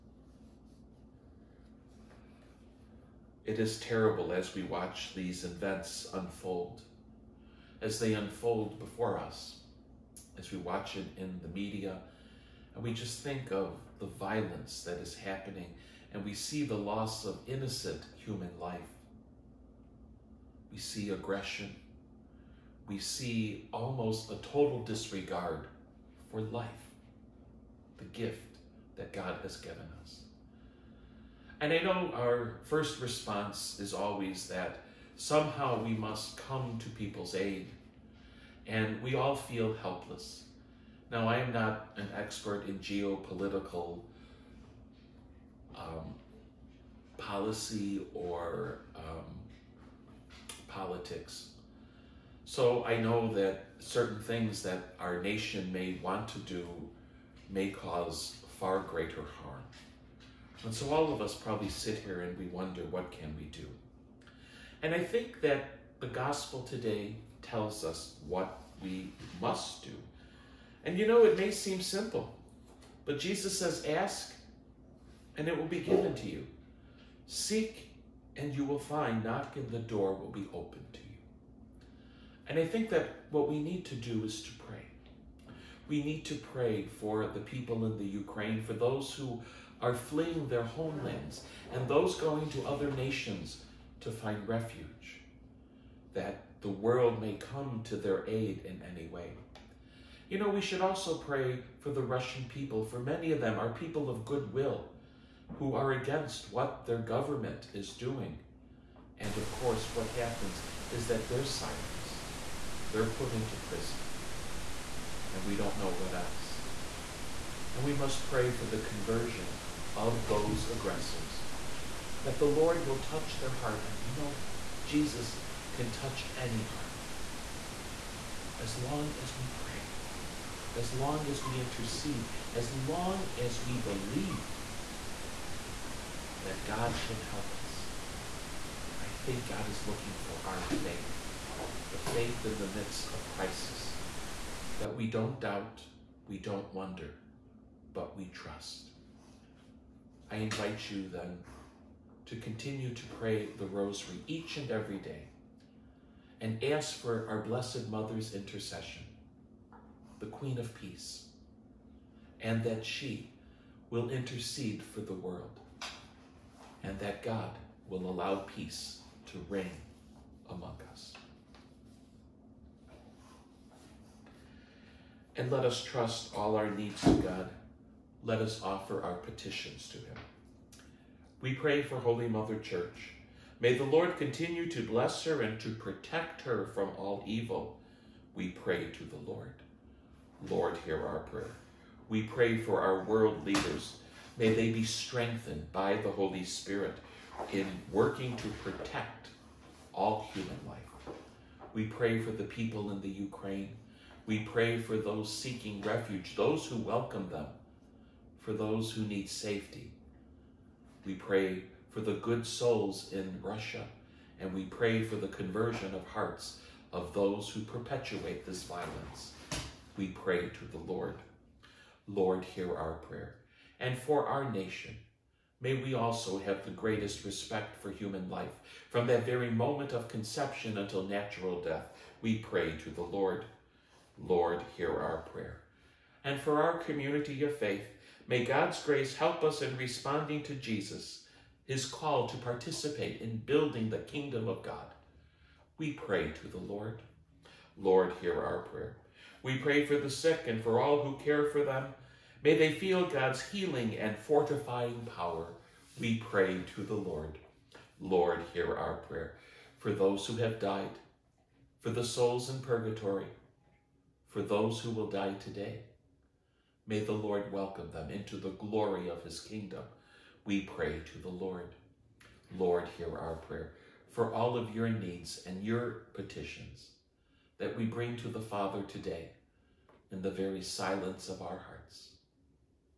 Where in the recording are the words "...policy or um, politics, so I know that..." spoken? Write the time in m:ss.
0:47.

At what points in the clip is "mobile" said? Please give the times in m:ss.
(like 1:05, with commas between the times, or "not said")
not said.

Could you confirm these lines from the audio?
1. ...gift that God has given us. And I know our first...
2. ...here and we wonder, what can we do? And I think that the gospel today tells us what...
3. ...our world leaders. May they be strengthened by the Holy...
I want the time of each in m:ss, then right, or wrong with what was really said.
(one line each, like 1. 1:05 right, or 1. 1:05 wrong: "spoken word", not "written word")
1. 0:28 right
2. 1:01 right
3. 3:12 right.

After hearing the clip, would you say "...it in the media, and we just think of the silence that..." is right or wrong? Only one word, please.
wrong.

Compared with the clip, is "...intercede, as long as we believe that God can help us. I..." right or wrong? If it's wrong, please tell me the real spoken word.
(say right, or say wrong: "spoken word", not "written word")
right.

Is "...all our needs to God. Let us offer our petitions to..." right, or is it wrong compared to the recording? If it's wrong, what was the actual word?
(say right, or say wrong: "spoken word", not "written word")
right.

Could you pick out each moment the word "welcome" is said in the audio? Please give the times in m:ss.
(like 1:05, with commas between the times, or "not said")
3:26, 4:27.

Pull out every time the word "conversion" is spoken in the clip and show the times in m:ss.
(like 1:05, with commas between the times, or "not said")
1:58, 3:35.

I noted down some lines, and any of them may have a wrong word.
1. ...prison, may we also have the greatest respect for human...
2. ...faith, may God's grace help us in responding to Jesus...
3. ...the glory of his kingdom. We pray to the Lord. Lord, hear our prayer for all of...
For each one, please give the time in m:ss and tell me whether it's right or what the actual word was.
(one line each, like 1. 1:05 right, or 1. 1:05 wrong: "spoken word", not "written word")
1. 3:44 wrong: "nation", not "prison"
2. 3:57 right
3. 4:28 right.